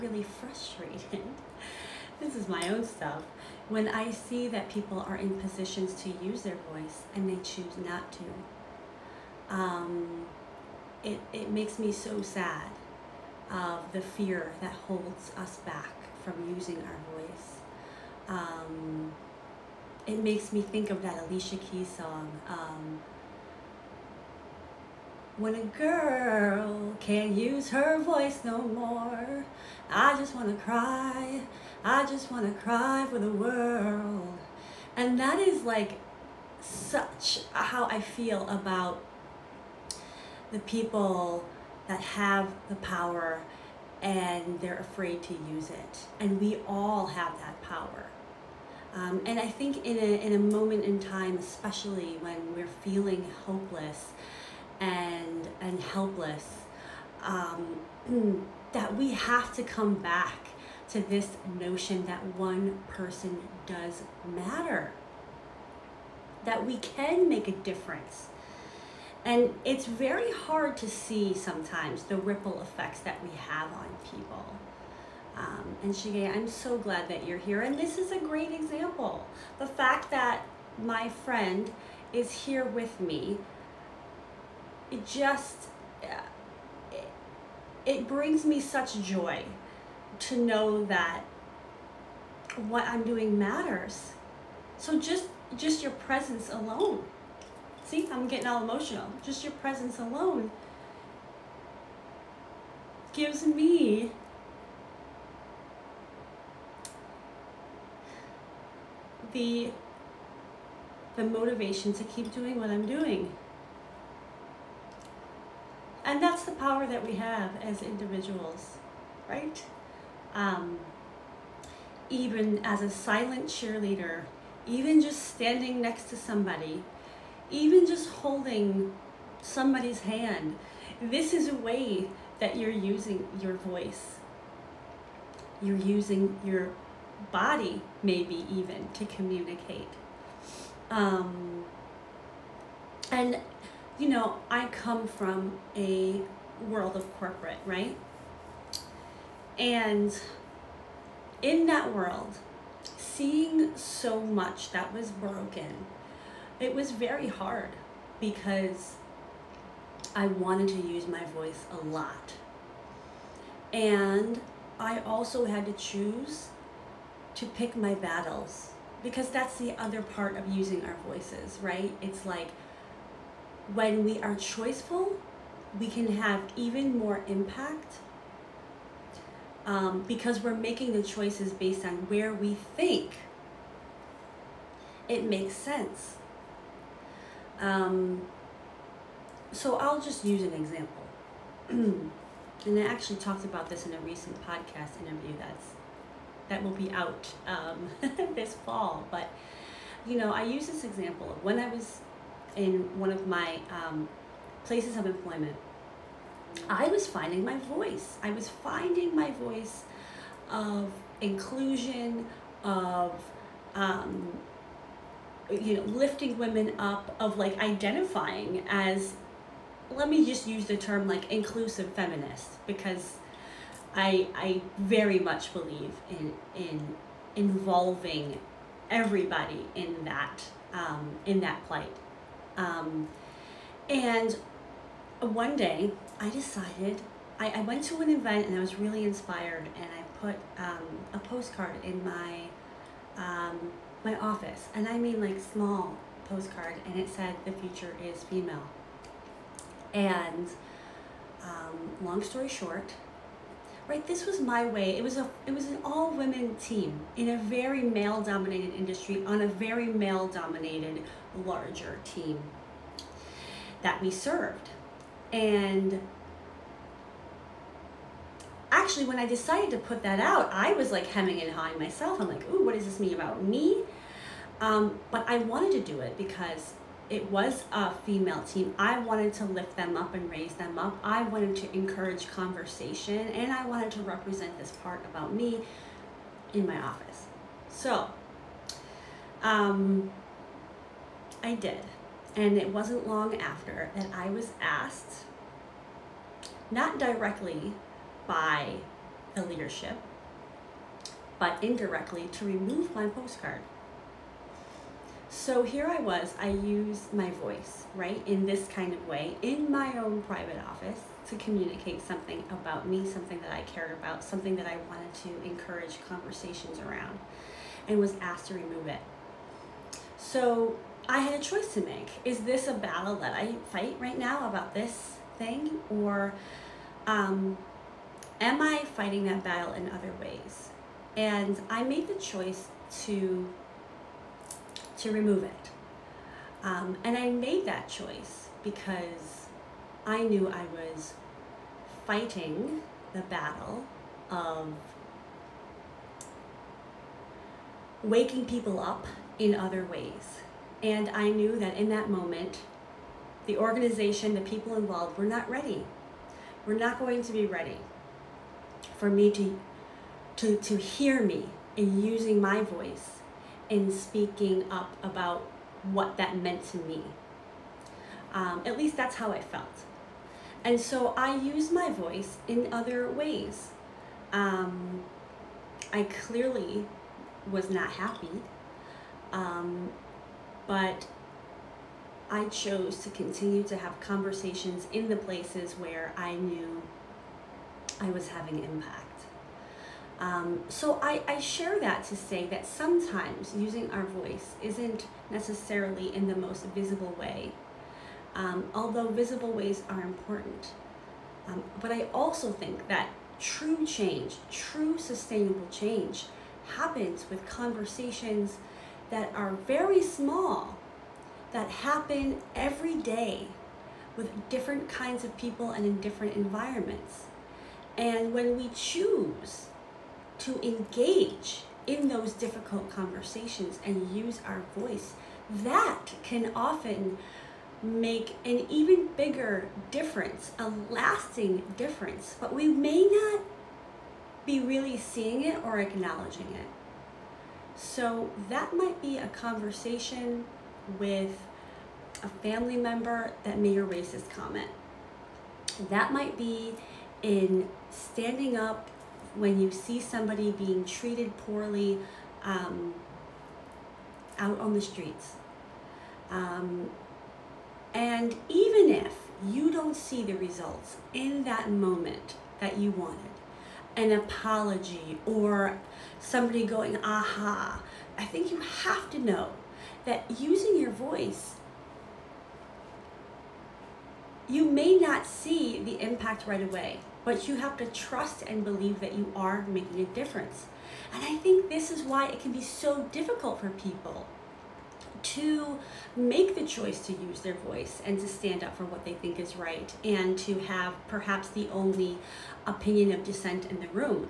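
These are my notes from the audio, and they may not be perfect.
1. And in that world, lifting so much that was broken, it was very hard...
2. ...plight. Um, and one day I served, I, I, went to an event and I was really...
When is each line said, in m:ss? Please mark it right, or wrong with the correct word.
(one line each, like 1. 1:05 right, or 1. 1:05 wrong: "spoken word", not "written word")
1. 2:29 wrong: "seeing", not "lifting"
2. 3:51 wrong: "decided", not "served".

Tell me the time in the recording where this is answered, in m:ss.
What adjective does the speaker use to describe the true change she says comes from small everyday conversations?
6:44.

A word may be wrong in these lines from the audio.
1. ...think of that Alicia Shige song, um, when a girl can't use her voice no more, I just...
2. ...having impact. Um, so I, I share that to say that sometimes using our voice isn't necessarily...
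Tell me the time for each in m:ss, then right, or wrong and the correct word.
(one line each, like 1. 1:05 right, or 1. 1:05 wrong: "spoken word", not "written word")
1. 0:20 wrong: "Keys", not "Shige"
2. 6:28 right.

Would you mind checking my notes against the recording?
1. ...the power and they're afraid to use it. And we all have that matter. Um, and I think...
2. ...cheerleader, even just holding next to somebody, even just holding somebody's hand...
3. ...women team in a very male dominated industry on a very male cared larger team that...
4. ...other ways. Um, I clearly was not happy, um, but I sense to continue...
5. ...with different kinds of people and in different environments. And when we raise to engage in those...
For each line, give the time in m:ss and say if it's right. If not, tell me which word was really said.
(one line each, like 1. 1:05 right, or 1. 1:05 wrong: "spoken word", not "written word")
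1. 0:42 wrong: "power", not "matter"
2. 2:03 wrong: "standing", not "holding"
3. 4:16 wrong: "dominated", not "cared"
4. 6:12 wrong: "chose", not "sense"
5. 6:54 wrong: "choose", not "raise".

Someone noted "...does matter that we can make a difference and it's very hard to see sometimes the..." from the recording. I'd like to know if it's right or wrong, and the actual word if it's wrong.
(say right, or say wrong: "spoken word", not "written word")
right.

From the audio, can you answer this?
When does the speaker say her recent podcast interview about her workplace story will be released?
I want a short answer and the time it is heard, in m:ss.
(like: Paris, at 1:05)
This fall, at 3:18.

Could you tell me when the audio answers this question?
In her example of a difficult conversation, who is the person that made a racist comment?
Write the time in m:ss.
7:22.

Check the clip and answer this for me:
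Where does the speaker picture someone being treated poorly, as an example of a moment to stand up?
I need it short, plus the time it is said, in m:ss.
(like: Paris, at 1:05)
Out on the streets, at 7:34.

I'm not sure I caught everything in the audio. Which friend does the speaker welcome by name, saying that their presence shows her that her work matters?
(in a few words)
Shige.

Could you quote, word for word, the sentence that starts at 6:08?
Um, at least that's how I felt.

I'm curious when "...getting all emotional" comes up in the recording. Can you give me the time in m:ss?
1:38.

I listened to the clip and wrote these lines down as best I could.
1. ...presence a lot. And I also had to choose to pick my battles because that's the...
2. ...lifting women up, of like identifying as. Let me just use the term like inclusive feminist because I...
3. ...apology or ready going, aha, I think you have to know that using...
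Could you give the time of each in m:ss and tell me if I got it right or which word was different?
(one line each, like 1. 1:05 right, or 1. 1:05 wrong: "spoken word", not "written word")
1. 2:41 wrong: "voice", not "presence"
2. 3:35 right
3. 7:44 wrong: "somebody", not "ready".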